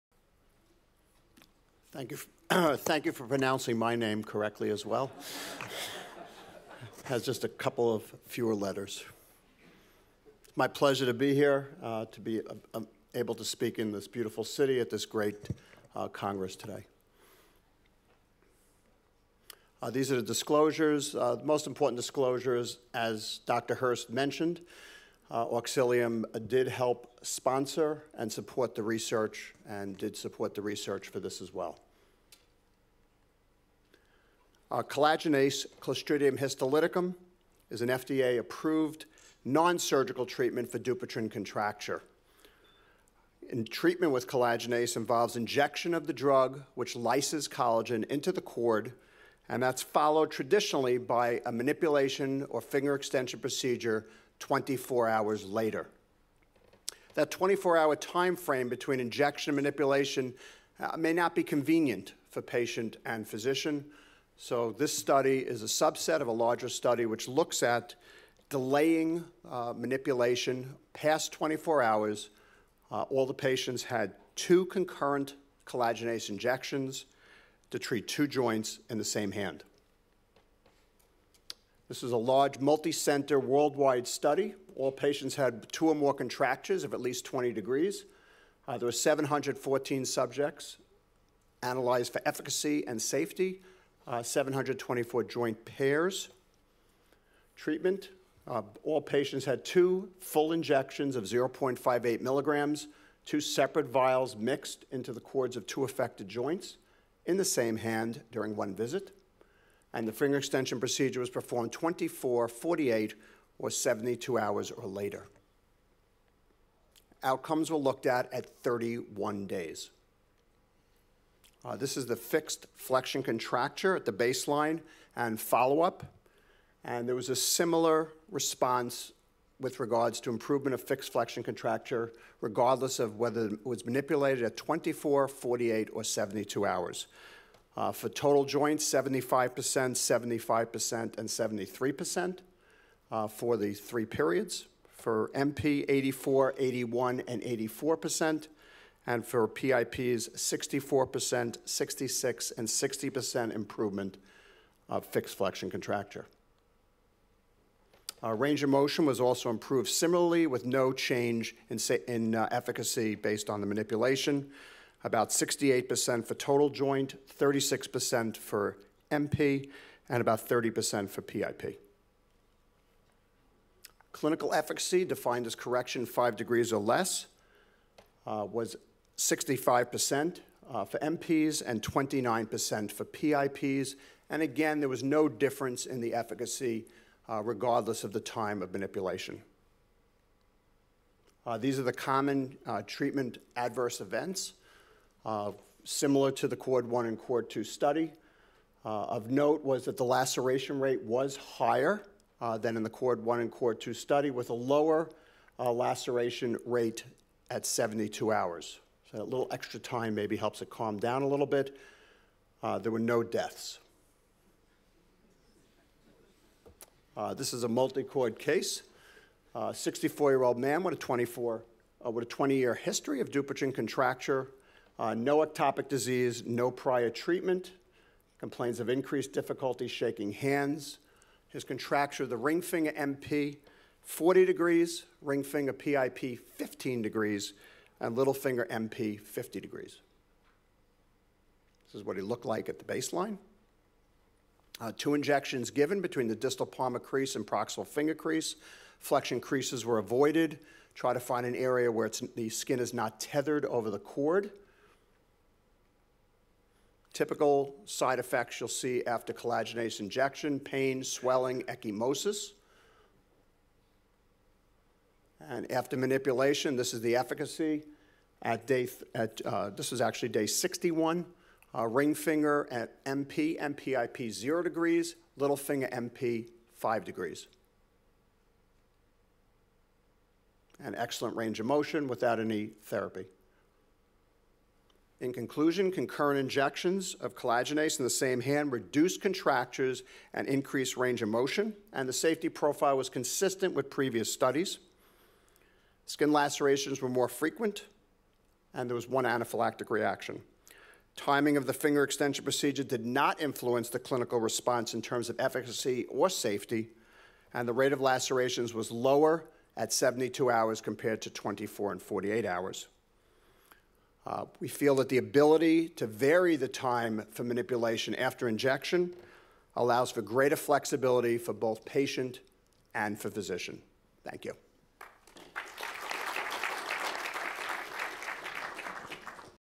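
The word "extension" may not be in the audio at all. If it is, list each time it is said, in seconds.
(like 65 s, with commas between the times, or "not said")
52 s, 110 s, 302 s.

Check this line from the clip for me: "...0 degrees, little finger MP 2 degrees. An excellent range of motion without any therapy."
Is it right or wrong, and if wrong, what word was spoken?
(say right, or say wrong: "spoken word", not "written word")
wrong: "5", not "2".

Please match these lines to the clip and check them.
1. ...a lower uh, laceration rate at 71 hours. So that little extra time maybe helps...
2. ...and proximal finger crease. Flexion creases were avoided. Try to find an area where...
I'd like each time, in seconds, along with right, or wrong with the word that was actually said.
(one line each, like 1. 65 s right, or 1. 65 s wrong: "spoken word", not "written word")
1. 204 s wrong: "72", not "71"
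2. 247 s right.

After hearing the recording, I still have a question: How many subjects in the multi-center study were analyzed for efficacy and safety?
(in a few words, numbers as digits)
714.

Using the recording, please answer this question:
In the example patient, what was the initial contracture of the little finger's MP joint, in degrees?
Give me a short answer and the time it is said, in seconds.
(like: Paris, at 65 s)
50 degrees, at 239 s.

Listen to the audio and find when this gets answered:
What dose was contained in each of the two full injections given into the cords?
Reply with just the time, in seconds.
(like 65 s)
101 s.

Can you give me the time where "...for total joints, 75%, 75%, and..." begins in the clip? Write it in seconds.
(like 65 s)
137 s.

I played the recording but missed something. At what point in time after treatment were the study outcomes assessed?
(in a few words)
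31 days.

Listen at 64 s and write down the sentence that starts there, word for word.
So, this study is a subset of a larger study which looks at delaying uh, manipulation past 24 hours.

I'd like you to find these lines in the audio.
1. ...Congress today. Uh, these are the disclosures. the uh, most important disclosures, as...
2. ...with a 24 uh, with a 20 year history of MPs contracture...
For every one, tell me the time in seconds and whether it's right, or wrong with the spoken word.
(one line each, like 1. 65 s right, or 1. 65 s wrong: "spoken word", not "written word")
1. 16 s right
2. 220 s wrong: "Dupuytren", not "MPs".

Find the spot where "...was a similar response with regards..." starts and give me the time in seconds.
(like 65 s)
127 s.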